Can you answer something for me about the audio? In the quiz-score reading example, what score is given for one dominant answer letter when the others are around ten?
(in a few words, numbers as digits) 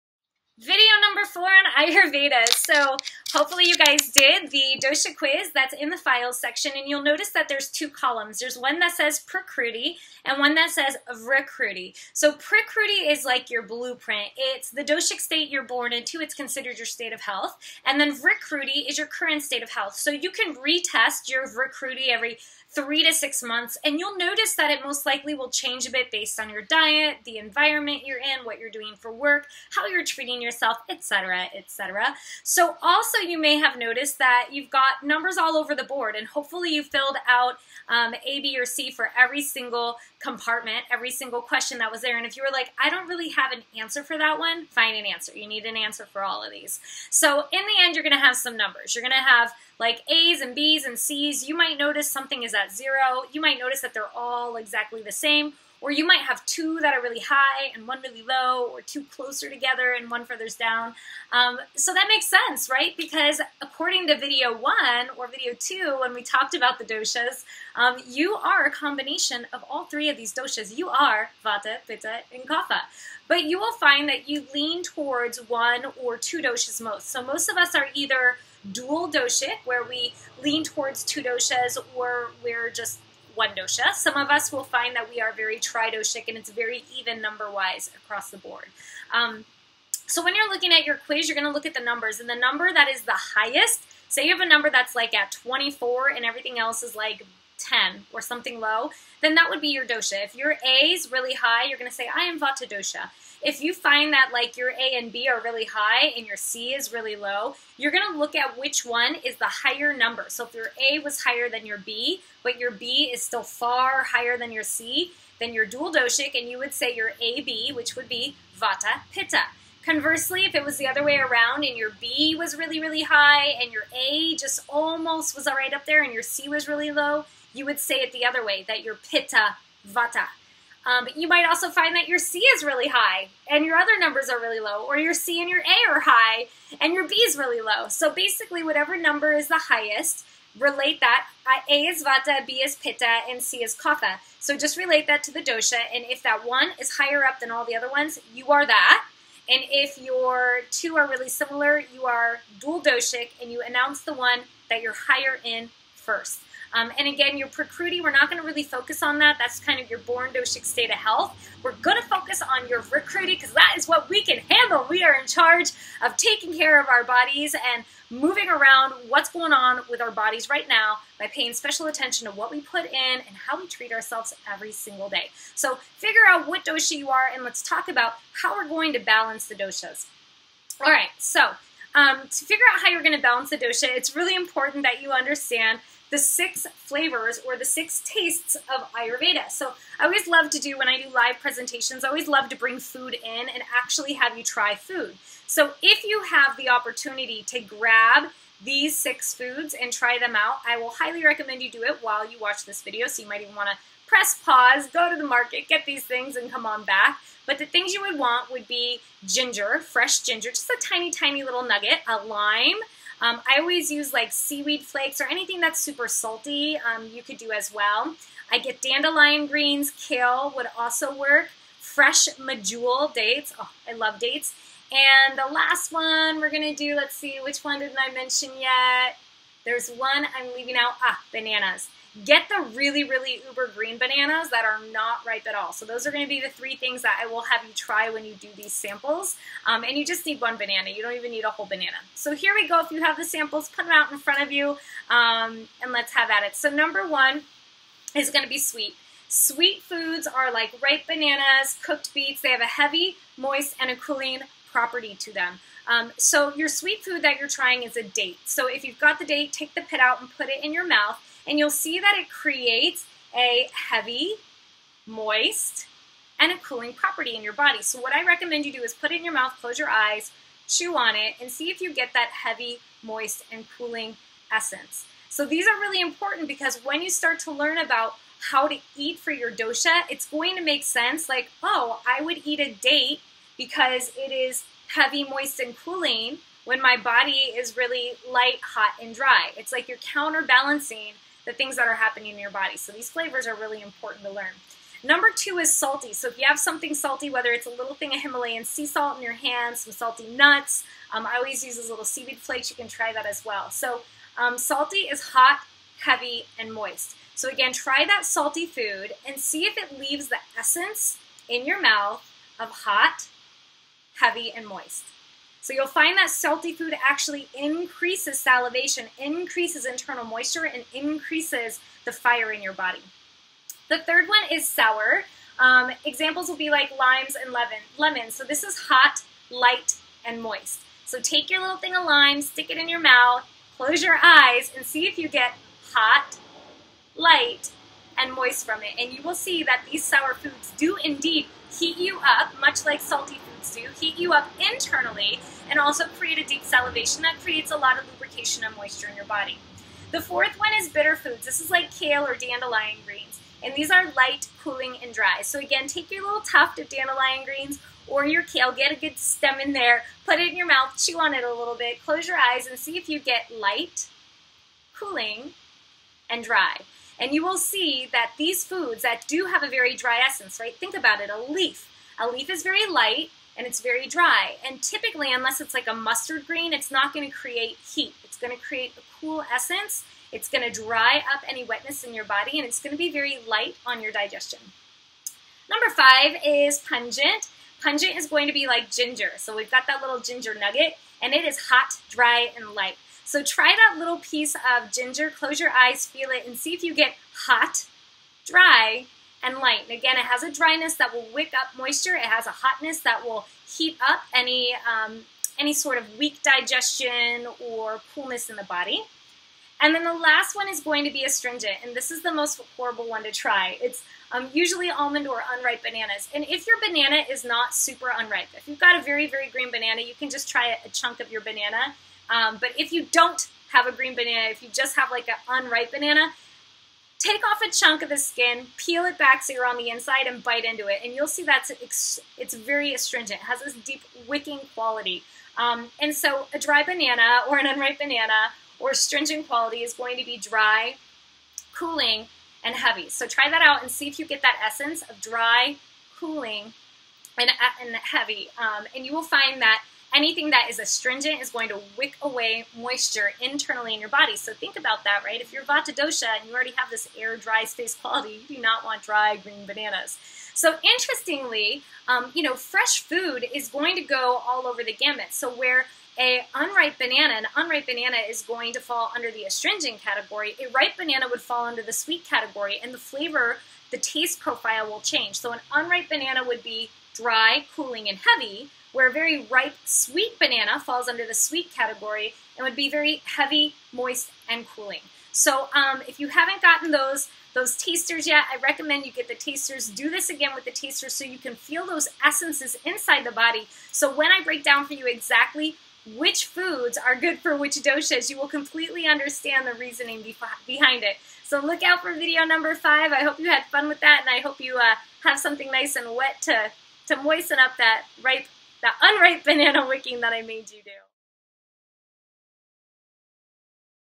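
24.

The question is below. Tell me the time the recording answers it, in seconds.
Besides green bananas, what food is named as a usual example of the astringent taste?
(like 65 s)
414 s.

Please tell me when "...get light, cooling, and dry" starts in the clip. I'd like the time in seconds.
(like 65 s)
363 s.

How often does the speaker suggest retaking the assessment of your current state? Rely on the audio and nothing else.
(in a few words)
every 3 to 6 months.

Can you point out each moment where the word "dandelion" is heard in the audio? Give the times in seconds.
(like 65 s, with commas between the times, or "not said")
218 s, 352 s, 356 s.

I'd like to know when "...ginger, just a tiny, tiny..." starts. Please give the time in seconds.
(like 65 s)
210 s.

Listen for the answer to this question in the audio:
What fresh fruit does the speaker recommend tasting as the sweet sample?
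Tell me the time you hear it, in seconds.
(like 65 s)
222 s.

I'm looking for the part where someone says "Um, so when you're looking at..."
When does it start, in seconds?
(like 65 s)
89 s.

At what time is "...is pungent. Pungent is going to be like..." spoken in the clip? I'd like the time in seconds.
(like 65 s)
386 s.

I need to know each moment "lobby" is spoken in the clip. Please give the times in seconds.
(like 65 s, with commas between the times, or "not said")
not said.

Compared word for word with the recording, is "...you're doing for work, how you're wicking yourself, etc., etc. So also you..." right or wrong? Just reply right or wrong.
wrong.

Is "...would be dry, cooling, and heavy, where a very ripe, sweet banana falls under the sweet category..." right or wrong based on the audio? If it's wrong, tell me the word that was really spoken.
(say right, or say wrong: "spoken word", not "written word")
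right.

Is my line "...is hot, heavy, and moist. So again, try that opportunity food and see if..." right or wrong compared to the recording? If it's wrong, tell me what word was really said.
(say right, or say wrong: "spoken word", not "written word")
wrong: "salty", not "opportunity".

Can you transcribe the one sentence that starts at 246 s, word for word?
So number one is going to be sweet.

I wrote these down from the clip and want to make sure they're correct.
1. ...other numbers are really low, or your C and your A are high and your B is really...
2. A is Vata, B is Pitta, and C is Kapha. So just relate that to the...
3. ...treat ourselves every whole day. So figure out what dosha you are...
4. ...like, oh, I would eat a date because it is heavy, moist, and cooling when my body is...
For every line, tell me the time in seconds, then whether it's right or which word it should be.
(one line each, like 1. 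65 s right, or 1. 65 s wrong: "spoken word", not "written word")
1. 133 s right
2. 141 s right
3. 173 s wrong: "single", not "whole"
4. 281 s right.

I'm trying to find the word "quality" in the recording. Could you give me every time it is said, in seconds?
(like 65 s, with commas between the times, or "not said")
434 s, 439 s, 457 s.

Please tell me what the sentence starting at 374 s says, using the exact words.
And typically, unless it's like a mustard green, it's not gonna create heat.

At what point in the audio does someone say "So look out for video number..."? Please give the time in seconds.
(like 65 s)
501 s.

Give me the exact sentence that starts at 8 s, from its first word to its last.
There's one that says Prakruti and one that says Vrikruti.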